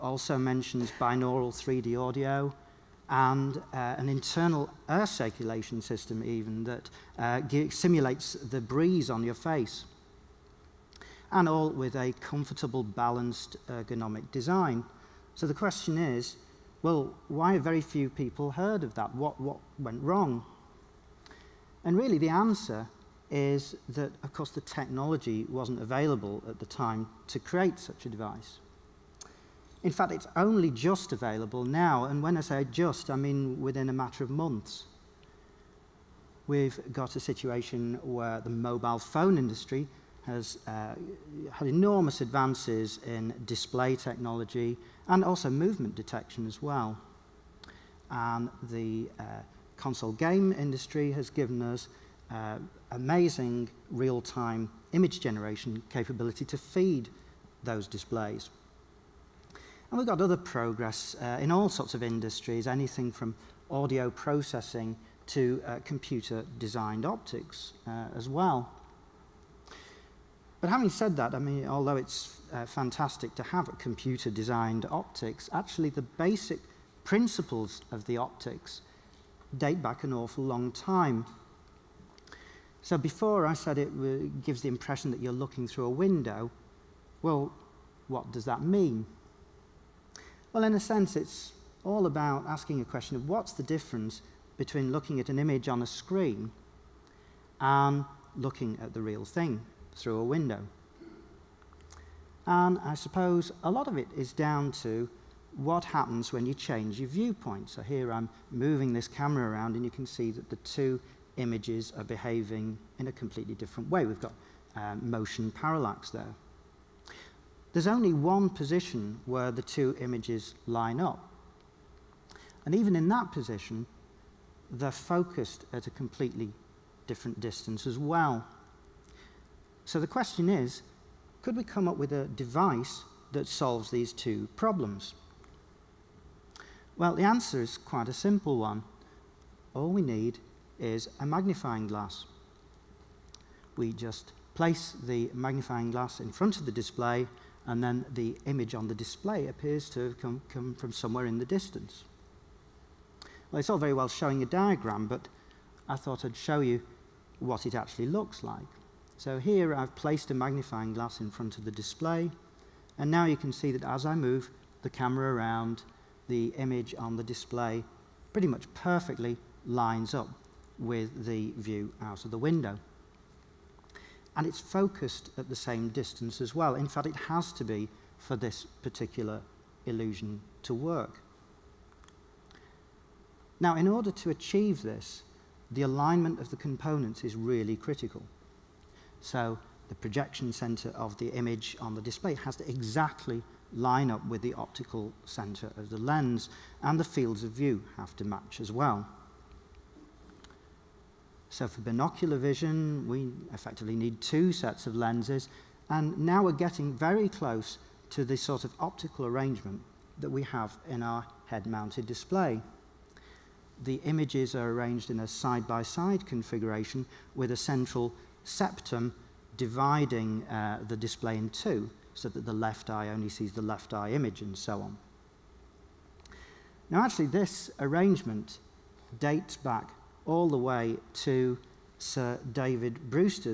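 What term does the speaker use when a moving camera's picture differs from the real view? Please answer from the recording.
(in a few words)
motion parallax.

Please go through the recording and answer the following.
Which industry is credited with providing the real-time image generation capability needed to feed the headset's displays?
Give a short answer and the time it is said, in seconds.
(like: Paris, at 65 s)
console game industry, at 49 s.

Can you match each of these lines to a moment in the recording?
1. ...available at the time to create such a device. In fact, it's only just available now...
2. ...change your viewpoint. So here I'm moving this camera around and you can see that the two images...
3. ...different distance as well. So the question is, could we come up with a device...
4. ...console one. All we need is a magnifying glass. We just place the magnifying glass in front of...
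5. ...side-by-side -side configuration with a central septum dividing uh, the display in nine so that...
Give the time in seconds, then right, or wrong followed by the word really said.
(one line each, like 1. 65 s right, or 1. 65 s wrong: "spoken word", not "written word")
1. 25 s right
2. 106 s right
3. 127 s right
4. 138 s wrong: "simple", not "console"
5. 215 s wrong: "two", not "nine".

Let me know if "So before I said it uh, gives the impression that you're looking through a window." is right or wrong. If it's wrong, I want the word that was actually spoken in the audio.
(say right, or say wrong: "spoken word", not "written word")
right.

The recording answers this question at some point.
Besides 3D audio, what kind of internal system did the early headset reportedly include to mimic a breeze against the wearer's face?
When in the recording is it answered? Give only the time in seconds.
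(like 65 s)
4 s.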